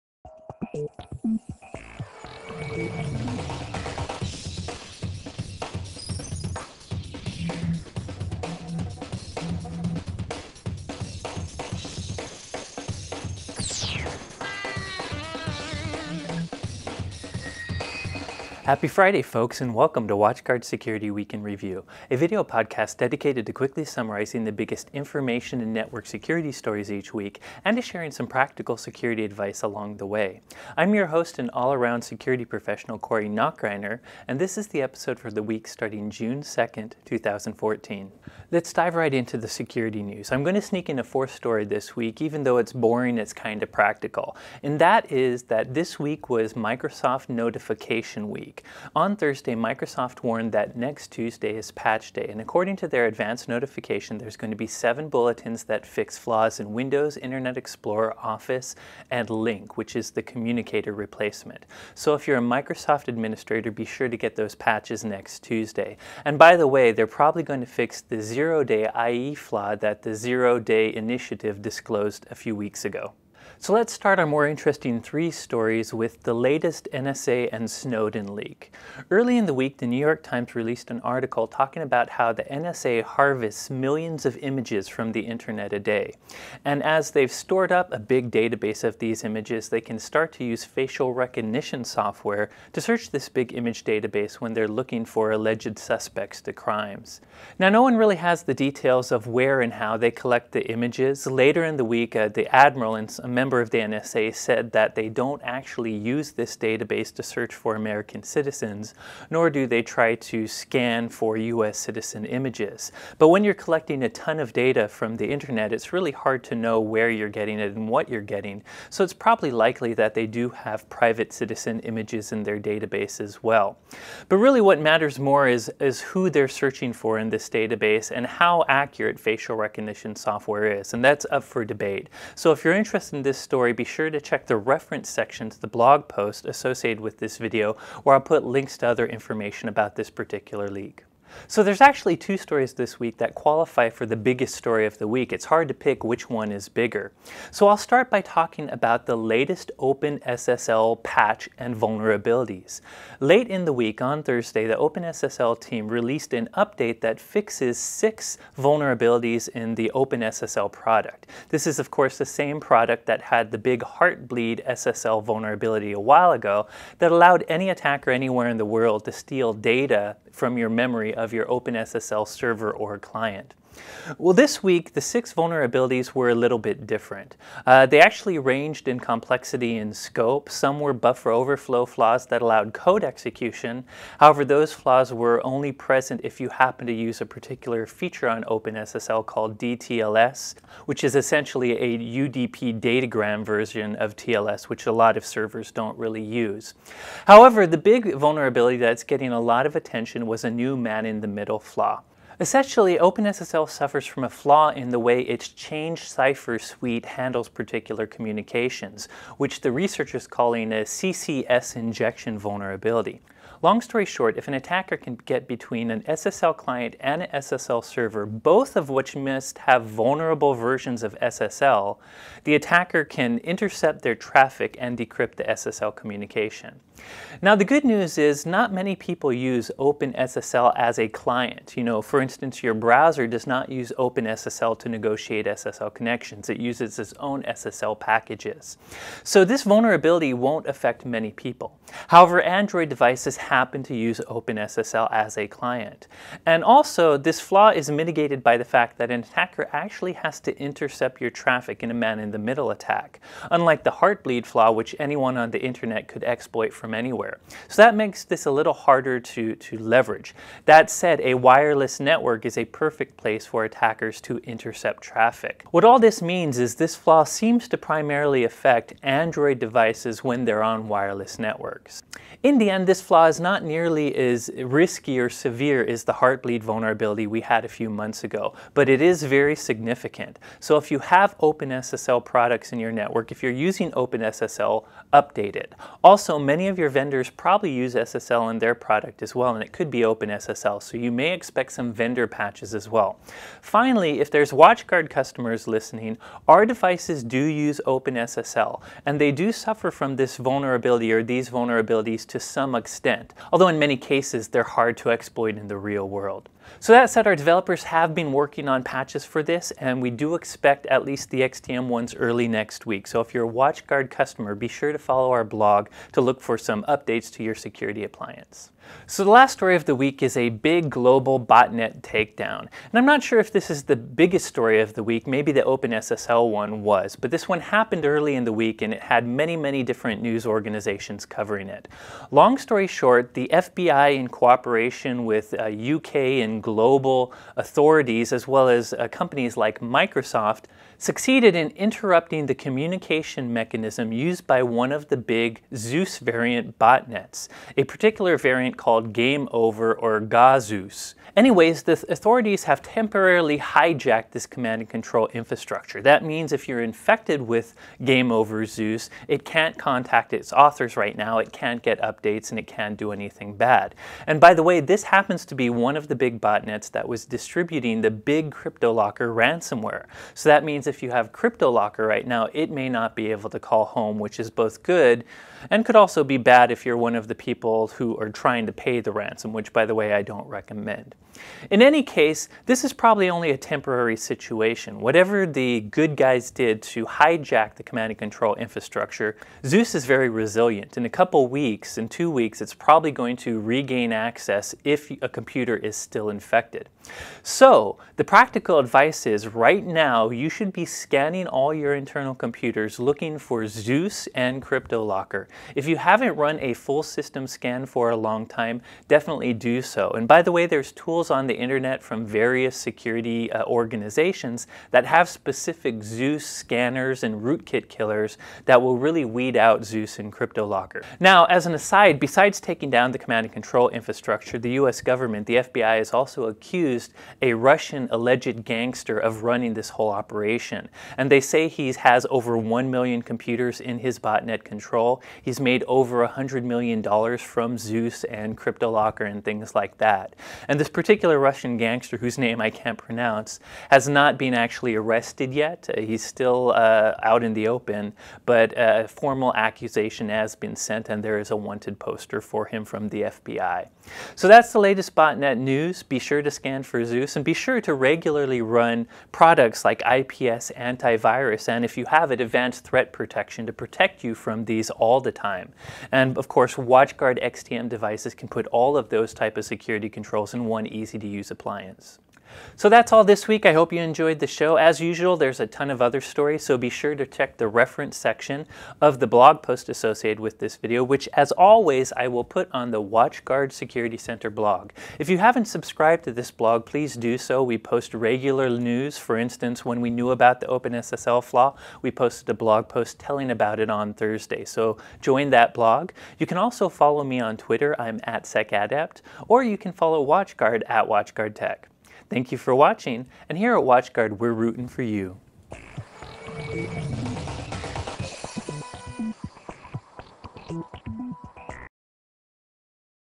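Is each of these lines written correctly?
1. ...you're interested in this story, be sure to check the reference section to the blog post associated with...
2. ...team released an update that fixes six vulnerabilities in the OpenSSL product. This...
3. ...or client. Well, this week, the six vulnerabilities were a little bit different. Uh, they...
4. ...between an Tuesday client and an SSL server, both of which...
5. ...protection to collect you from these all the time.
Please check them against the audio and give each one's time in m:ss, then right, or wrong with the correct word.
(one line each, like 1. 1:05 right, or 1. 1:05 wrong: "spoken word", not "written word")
1. 2:12 right
2. 2:35 right
3. 2:52 right
4. 3:35 wrong: "SSL", not "Tuesday"
5. 7:43 wrong: "protect", not "collect".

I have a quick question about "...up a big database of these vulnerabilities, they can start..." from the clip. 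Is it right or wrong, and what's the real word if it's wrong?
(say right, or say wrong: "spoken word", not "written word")
wrong: "images", not "vulnerabilities".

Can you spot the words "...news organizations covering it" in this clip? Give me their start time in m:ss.
5:30.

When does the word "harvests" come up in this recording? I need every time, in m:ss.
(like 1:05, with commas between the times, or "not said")
1:23.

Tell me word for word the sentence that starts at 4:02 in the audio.
However, Android devices devices happen to use OpenSSL as a client.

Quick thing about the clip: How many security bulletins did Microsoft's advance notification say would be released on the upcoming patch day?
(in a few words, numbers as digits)
7.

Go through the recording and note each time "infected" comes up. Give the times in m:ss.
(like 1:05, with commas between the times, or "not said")
5:56, 6:36.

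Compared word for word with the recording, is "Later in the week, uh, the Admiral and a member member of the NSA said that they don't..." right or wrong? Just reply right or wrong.
right.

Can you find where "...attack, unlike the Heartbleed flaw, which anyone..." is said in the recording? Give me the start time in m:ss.
4:12.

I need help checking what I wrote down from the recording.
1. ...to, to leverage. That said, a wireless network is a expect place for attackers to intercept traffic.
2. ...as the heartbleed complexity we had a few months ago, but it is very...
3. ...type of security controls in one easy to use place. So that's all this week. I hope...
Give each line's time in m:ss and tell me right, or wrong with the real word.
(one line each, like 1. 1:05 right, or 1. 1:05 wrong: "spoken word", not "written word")
1. 4:19 wrong: "perfect", not "expect"
2. 4:35 wrong: "vulnerability", not "complexity"
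3. 7:49 wrong: "appliance", not "place".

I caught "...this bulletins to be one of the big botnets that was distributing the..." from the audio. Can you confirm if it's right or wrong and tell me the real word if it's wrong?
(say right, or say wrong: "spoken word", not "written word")
wrong: "happens", not "bulletins".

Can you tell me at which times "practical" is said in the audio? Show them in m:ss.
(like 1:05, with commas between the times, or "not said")
0:28, 0:43, 6:38.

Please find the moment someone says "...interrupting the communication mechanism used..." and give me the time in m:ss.
5:41.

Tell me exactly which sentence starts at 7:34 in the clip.
So that's the latest botnet news.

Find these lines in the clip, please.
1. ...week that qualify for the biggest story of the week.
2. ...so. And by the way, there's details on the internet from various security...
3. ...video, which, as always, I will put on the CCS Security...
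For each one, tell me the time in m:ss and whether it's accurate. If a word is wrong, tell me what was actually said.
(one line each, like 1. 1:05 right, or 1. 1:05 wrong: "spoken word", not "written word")
1. 2:22 right
2. 6:49 wrong: "tools", not "details"
3. 8:00 wrong: "WatchGuard", not "CCS".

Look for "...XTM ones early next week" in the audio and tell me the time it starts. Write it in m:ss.
5:11.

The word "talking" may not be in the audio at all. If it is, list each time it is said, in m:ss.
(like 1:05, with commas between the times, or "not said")
1:21, 2:28.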